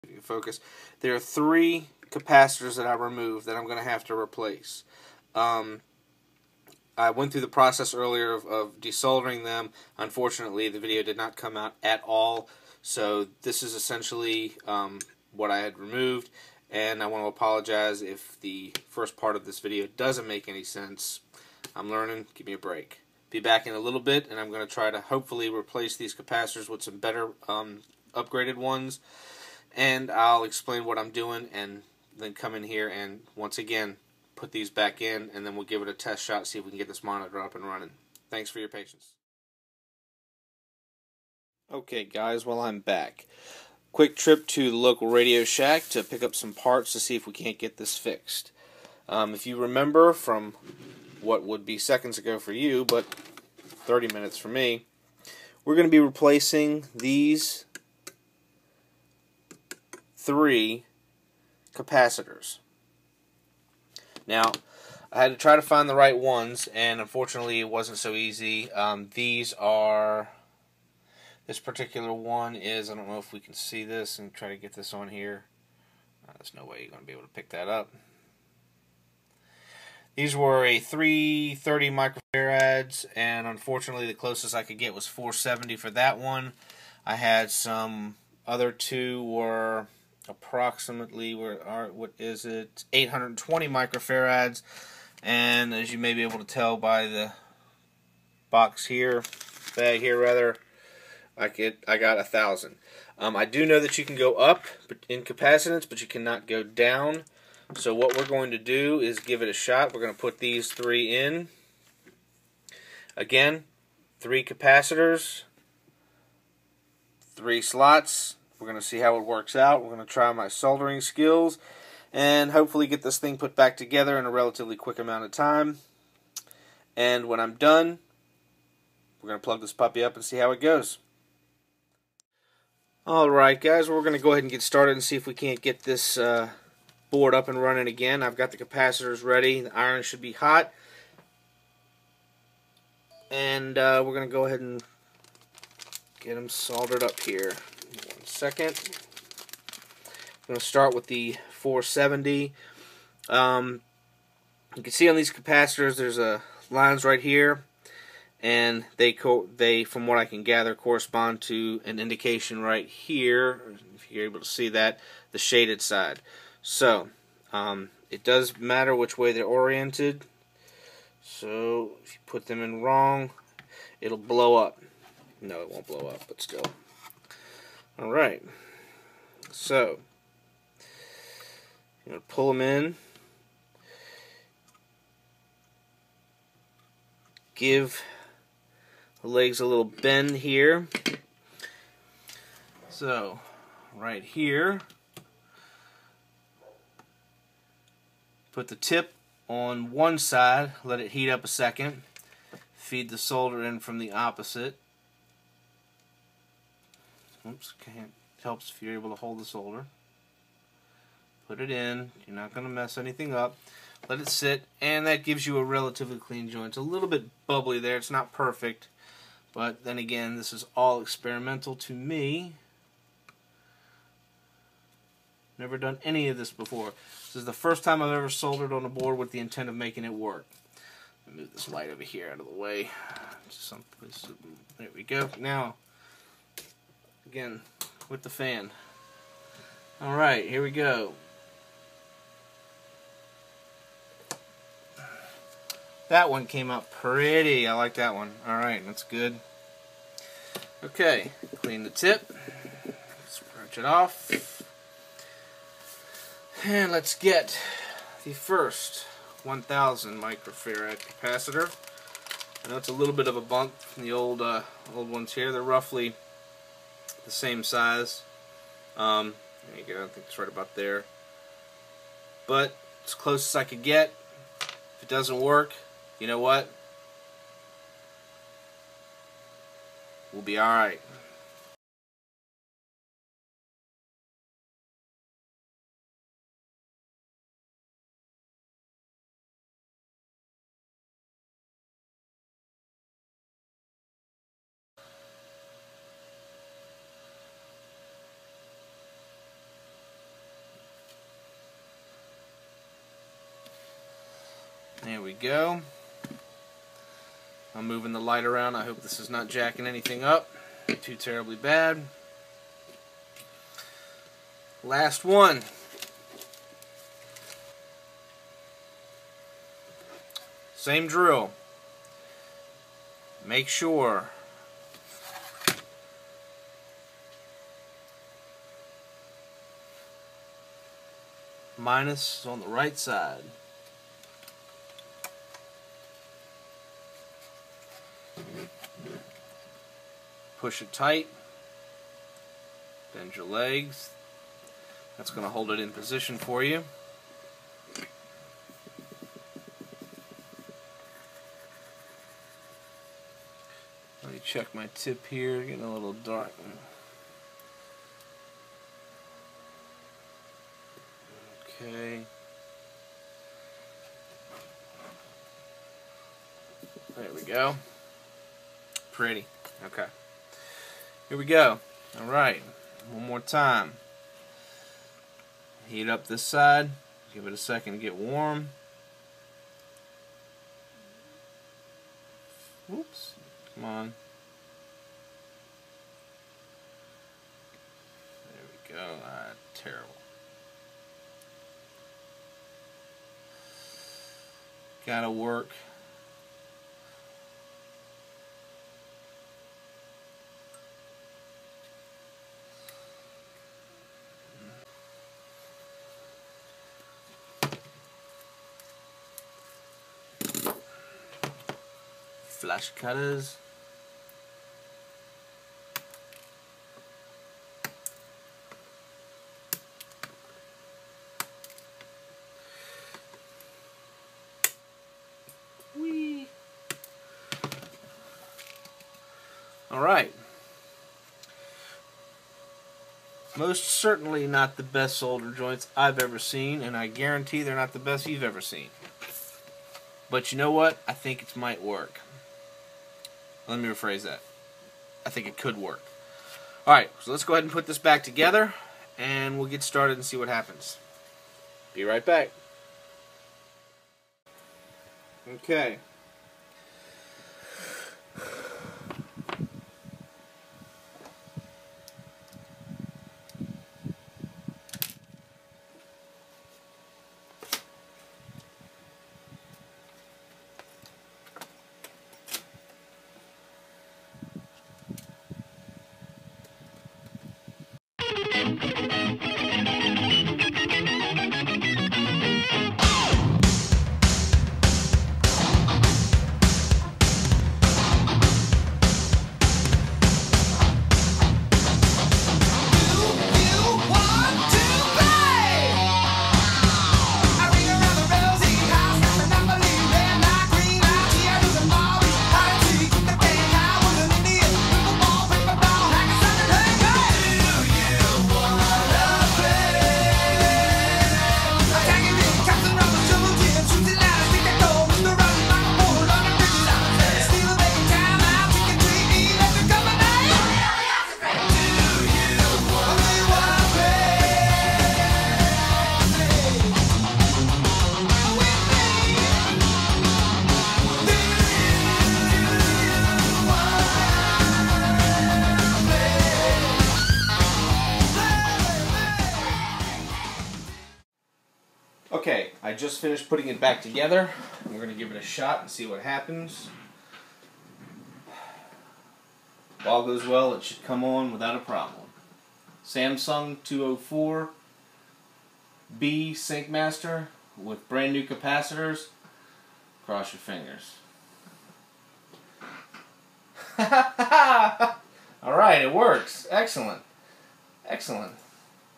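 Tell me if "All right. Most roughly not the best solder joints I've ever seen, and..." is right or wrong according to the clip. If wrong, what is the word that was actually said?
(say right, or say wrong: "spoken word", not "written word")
wrong: "certainly", not "roughly".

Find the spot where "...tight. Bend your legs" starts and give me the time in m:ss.
5:40.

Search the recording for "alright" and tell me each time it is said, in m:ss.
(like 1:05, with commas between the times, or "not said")
2:13, 4:00, 4:08, 4:40.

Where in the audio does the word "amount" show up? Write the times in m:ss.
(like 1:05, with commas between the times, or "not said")
2:04.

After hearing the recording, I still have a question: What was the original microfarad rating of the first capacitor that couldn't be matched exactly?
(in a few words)
330 microfarads.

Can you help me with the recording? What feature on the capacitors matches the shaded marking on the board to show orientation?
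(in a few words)
lines.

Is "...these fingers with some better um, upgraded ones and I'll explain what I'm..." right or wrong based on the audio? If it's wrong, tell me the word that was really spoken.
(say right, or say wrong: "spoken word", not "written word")
wrong: "capacitors", not "fingers".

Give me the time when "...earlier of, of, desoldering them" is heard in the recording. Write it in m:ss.
0:07.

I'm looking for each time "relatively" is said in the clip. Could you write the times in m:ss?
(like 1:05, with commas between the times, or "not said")
2:04, 3:35.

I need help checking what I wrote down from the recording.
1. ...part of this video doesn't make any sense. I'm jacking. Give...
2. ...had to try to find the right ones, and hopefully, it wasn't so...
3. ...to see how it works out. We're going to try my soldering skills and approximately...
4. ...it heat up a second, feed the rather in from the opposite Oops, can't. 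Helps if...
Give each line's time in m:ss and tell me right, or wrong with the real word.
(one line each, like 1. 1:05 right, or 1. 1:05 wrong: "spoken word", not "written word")
1. 0:19 wrong: "learning", not "jacking"
2. 1:05 wrong: "unfortunately", not "hopefully"
3. 1:58 wrong: "hopefully", not "approximately"
4. 3:20 wrong: "solder", not "rather".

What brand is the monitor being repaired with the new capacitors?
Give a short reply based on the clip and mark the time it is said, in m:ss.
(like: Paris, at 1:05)
Samsung, at 9:13.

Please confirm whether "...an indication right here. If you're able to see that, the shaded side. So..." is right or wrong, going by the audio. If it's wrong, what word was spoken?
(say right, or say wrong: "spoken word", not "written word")
right.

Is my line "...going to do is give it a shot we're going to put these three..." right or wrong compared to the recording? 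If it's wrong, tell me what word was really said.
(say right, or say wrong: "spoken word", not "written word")
right.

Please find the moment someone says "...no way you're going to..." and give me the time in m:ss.
1:16.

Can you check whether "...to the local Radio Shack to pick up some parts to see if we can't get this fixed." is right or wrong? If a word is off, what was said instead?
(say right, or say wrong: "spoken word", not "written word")
right.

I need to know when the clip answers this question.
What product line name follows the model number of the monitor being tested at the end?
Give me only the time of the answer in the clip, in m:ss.
9:16.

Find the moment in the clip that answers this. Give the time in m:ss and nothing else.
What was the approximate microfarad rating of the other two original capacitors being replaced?
1:32.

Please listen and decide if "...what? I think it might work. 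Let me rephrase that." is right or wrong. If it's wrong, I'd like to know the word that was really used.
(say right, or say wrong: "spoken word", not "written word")
right.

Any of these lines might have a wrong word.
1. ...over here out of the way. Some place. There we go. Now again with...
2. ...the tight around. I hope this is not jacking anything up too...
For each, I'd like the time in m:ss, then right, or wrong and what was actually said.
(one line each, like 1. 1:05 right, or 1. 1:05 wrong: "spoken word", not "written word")
1. 3:51 right
2. 5:08 wrong: "light", not "tight".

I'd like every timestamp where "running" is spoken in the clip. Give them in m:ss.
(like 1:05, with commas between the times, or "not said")
0:37, 2:17.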